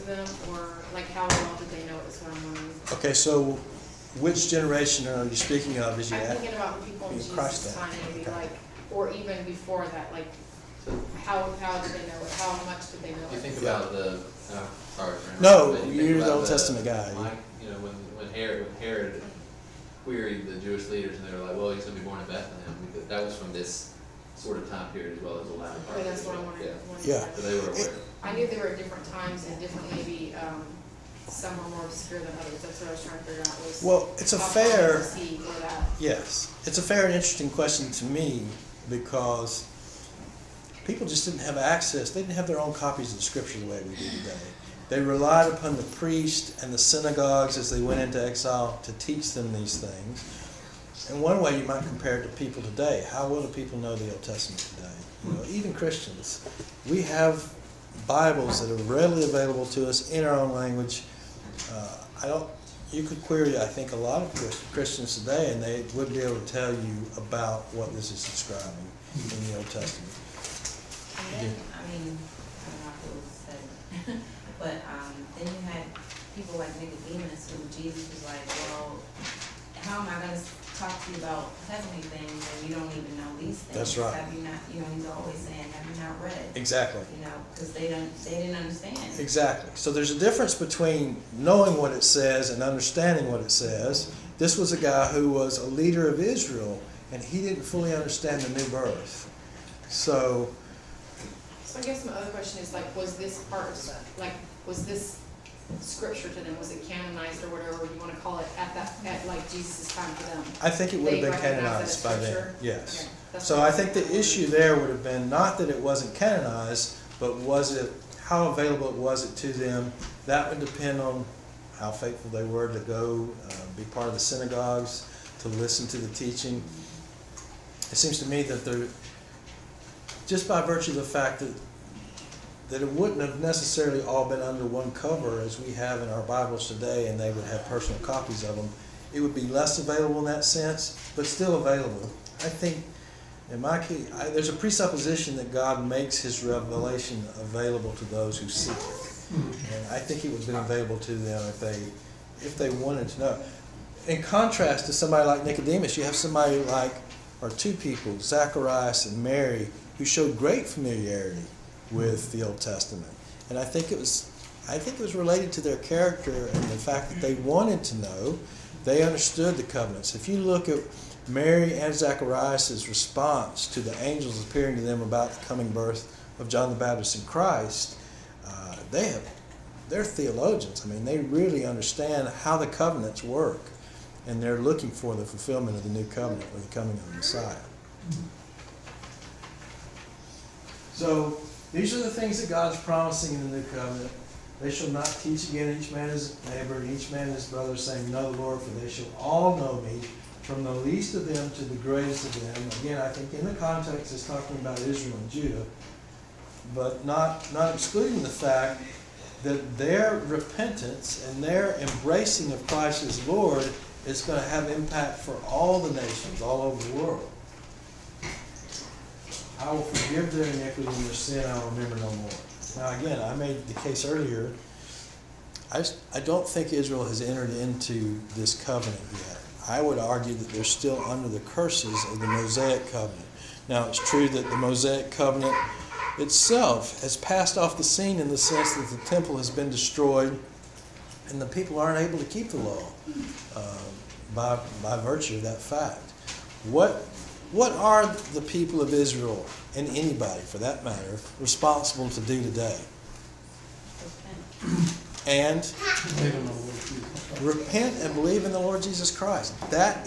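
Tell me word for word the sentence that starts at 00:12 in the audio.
How much did they know You think about the, uh, sorry.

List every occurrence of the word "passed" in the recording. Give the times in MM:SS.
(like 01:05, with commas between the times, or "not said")
03:57.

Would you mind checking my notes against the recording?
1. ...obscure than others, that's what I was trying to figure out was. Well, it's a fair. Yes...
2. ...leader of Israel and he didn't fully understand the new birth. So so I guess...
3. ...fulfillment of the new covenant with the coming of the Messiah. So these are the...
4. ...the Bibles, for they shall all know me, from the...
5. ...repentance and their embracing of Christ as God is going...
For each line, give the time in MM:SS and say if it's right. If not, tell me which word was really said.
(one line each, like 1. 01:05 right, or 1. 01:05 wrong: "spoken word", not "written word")
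1. 00:31 right
2. 01:35 right
3. 03:05 right
4. 03:18 wrong: "Lord", not "Bibles"
5. 03:30 wrong: "Lord", not "God".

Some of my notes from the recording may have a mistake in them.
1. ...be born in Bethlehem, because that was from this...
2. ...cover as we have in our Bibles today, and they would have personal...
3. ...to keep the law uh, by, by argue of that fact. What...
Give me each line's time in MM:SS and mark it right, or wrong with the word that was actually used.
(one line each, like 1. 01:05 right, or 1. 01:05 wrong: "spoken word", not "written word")
1. 00:21 right
2. 02:14 right
3. 04:02 wrong: "virtue", not "argue".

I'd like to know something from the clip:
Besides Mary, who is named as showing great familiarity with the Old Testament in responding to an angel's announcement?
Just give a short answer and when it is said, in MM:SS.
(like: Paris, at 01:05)
Zacharias, at 02:38.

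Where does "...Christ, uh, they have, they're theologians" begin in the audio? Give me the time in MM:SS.
02:57.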